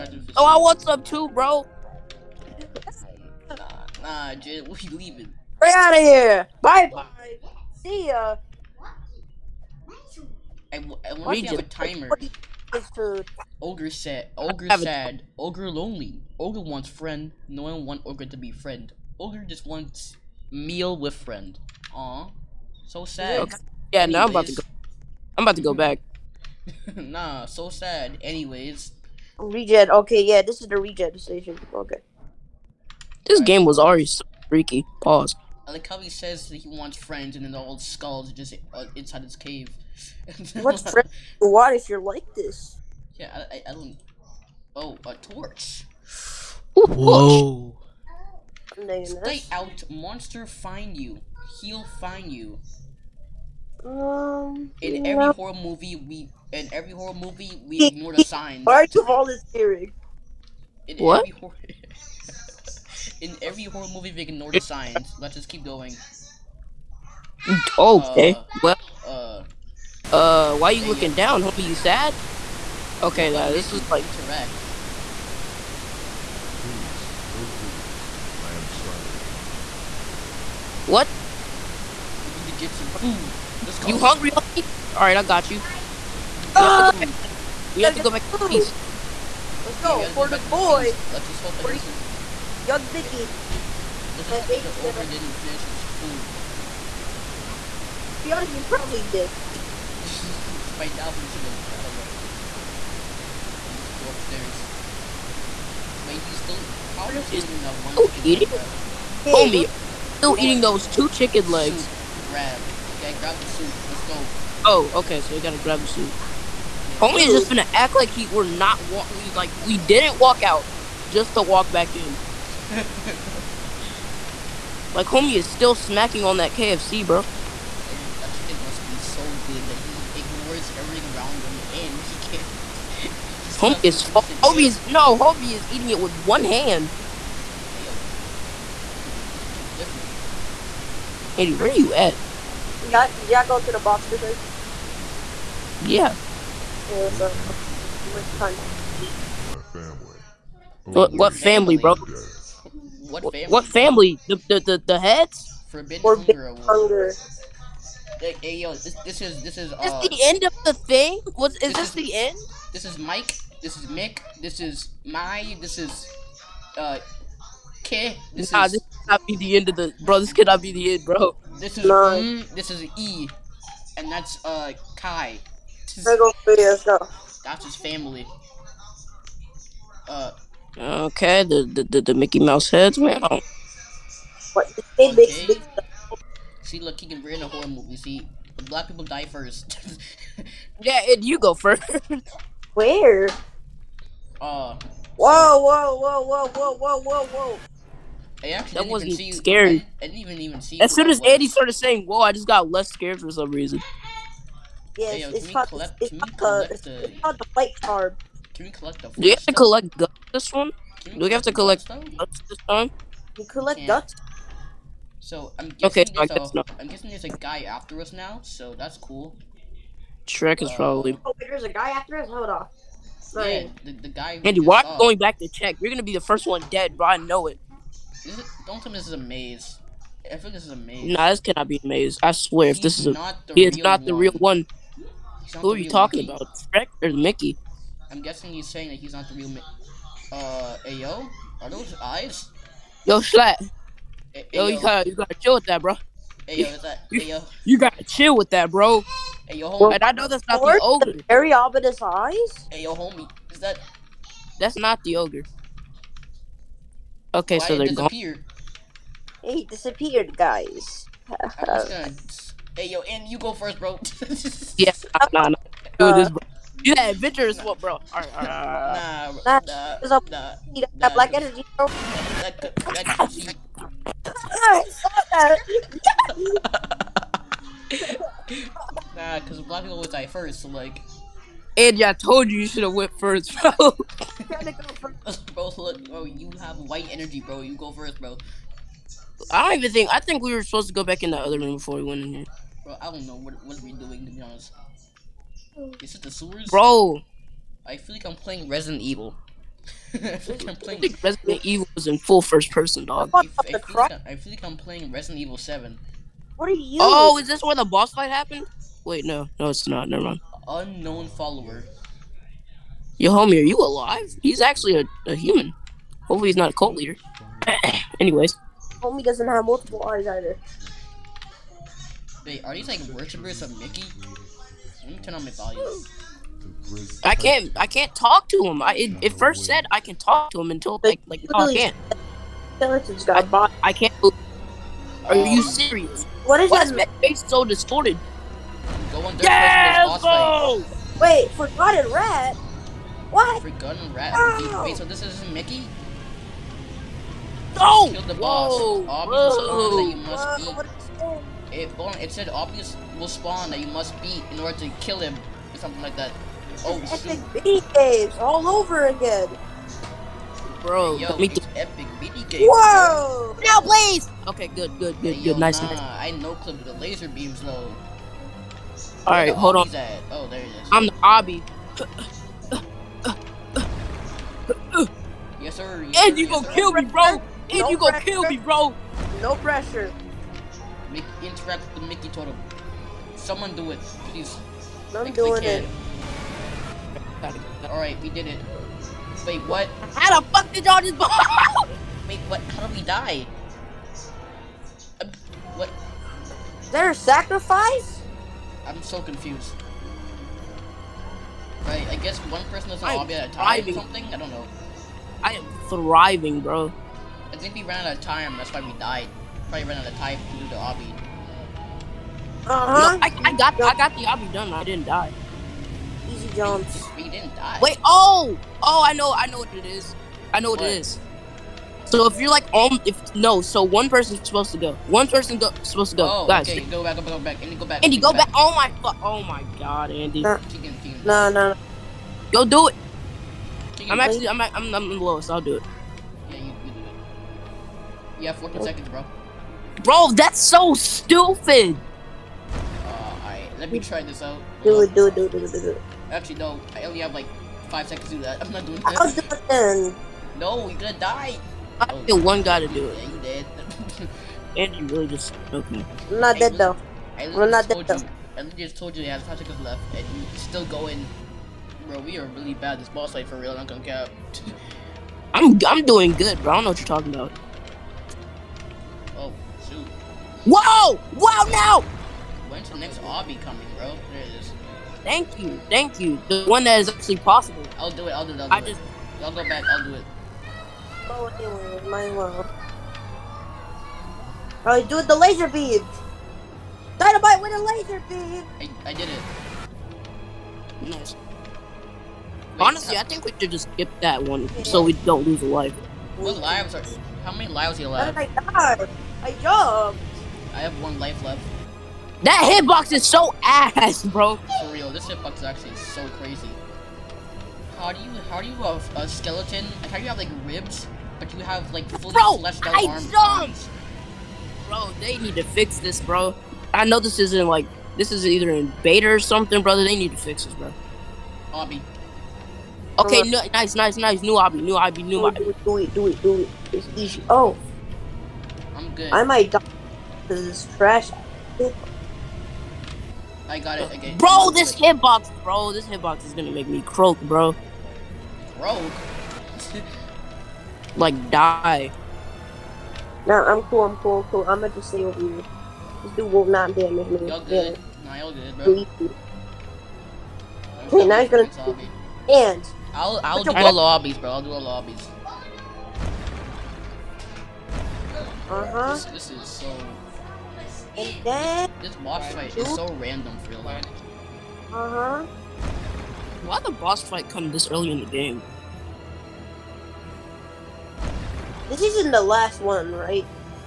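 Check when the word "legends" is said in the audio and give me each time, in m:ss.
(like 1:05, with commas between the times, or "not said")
not said.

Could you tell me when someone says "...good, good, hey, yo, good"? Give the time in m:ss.
6:04.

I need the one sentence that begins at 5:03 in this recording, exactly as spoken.
I, I, feel like I feel like I'm playing Resident Evil 7.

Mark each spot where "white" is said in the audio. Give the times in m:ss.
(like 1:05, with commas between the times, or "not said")
4:46.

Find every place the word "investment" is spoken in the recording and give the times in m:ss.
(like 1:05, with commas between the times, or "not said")
not said.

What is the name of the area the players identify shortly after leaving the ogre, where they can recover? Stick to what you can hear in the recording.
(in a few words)
regen station.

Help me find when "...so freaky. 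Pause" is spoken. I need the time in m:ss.
0:34.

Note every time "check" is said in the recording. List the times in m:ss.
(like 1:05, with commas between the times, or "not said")
3:45.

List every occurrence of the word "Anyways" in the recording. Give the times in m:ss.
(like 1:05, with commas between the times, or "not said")
0:28, 5:18.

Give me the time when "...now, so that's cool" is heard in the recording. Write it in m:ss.
3:38.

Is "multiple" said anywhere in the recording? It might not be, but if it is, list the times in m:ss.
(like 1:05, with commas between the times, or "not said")
5:19.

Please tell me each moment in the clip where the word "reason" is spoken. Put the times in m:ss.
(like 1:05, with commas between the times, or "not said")
3:23.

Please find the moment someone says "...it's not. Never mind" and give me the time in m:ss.
5:09.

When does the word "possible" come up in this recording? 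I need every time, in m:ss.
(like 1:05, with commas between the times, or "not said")
7:57.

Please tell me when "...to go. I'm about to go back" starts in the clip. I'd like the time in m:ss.
0:24.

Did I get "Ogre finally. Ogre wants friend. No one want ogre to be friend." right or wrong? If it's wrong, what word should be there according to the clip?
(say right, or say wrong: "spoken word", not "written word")
wrong: "lonely", not "finally".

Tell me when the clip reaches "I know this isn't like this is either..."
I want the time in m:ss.
8:36.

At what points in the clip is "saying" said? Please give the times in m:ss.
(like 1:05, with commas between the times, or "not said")
3:21, 3:58.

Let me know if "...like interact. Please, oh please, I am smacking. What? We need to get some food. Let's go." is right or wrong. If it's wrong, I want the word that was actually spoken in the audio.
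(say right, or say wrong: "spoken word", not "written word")
wrong: "starving", not "smacking".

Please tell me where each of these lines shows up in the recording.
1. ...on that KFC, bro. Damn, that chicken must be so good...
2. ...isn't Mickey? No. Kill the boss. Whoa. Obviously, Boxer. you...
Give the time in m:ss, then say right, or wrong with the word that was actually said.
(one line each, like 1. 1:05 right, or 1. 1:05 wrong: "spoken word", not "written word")
1. 2:06 right
2. 5:45 wrong: "Whoa", not "Boxer".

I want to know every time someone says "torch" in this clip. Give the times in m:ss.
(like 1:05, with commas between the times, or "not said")
0:45.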